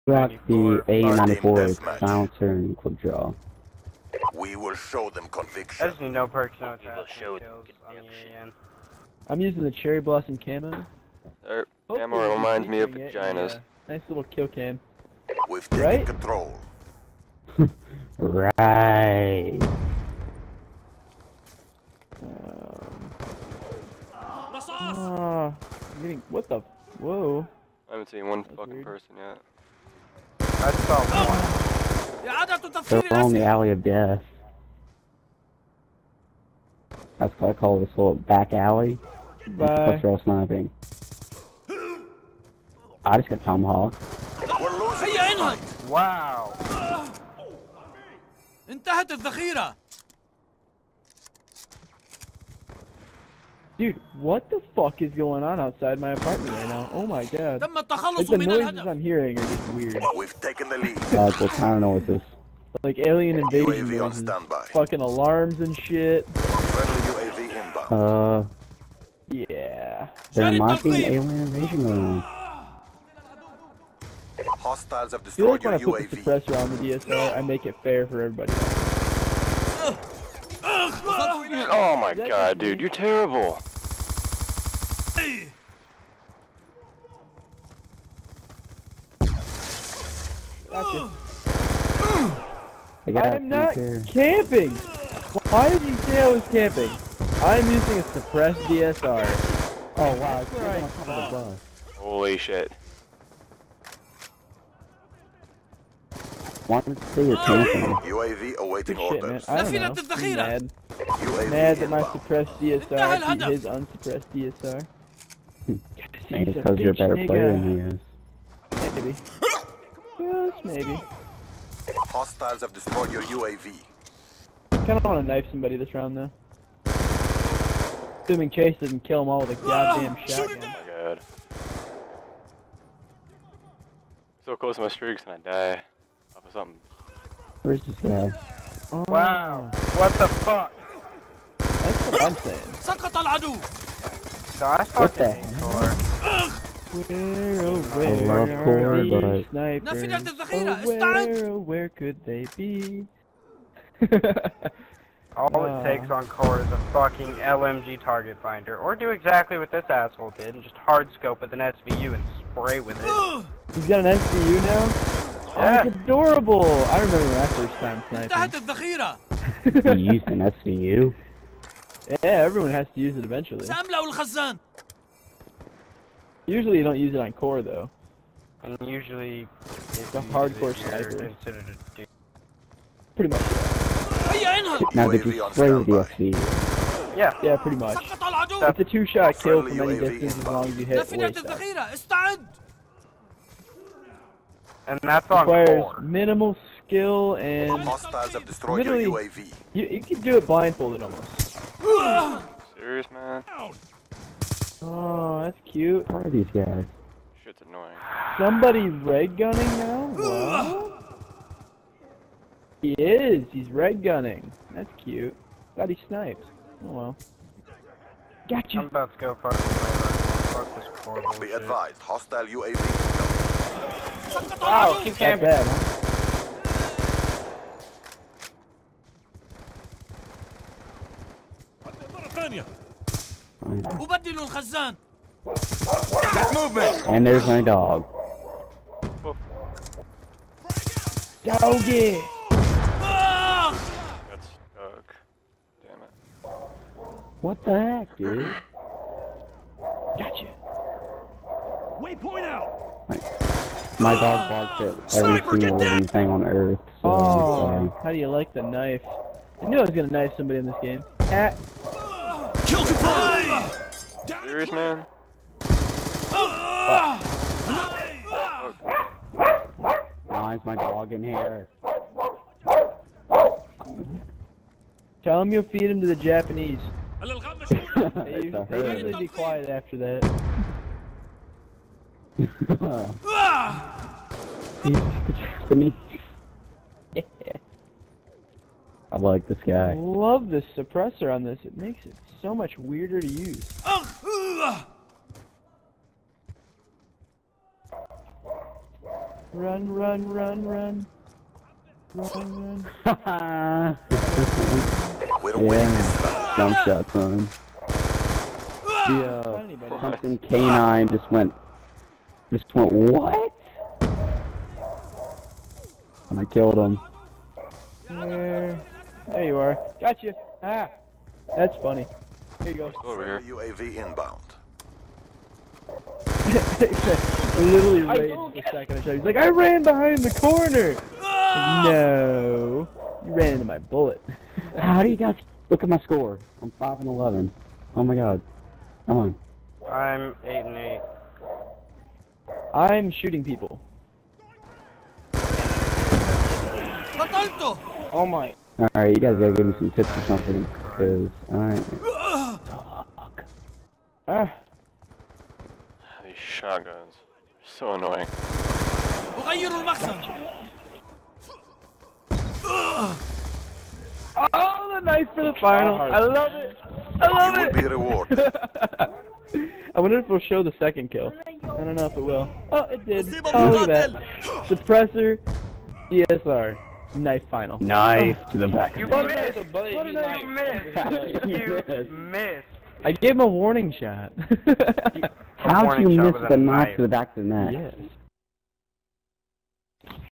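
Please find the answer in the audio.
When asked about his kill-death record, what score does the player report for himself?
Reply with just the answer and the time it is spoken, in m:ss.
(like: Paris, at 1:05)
5 and 11, at 5:36.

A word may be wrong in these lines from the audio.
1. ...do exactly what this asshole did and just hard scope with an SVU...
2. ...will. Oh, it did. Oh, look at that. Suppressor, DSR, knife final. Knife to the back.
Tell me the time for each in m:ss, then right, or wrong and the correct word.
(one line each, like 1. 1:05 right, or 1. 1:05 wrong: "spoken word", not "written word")
1. 2:38 right
2. 6:12 right.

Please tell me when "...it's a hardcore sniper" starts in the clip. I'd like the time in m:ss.
2:59.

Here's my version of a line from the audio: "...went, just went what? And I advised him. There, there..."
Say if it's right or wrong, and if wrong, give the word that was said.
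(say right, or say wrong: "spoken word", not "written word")
wrong: "killed", not "advised".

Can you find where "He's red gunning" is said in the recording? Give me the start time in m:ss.
3:33.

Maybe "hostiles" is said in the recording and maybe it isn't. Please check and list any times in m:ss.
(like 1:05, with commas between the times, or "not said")
1:14, 2:02, 3:42.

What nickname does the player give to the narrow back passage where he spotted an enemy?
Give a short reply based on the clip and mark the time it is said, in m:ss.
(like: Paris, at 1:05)
Alley of death, at 0:33.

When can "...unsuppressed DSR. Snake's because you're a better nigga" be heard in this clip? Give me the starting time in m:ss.
1:53.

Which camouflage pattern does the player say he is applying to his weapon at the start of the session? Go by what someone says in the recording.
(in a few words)
Cherry blossom.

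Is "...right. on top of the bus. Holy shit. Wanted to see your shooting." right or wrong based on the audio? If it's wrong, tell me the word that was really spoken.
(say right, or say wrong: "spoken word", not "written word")
wrong: "camping", not "shooting".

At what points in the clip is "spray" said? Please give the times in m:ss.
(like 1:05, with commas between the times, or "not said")
2:42, 3:05.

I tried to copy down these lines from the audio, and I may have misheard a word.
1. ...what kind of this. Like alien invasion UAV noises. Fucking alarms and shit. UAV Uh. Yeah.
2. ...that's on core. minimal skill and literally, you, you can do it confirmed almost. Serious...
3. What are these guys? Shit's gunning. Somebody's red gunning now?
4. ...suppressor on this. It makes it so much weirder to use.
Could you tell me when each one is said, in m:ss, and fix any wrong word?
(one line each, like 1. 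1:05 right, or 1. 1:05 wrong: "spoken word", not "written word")
1. 1:01 right
2. 3:15 wrong: "blindfolded", not "confirmed"
3. 3:26 wrong: "annoying", not "gunning"
4. 4:50 right.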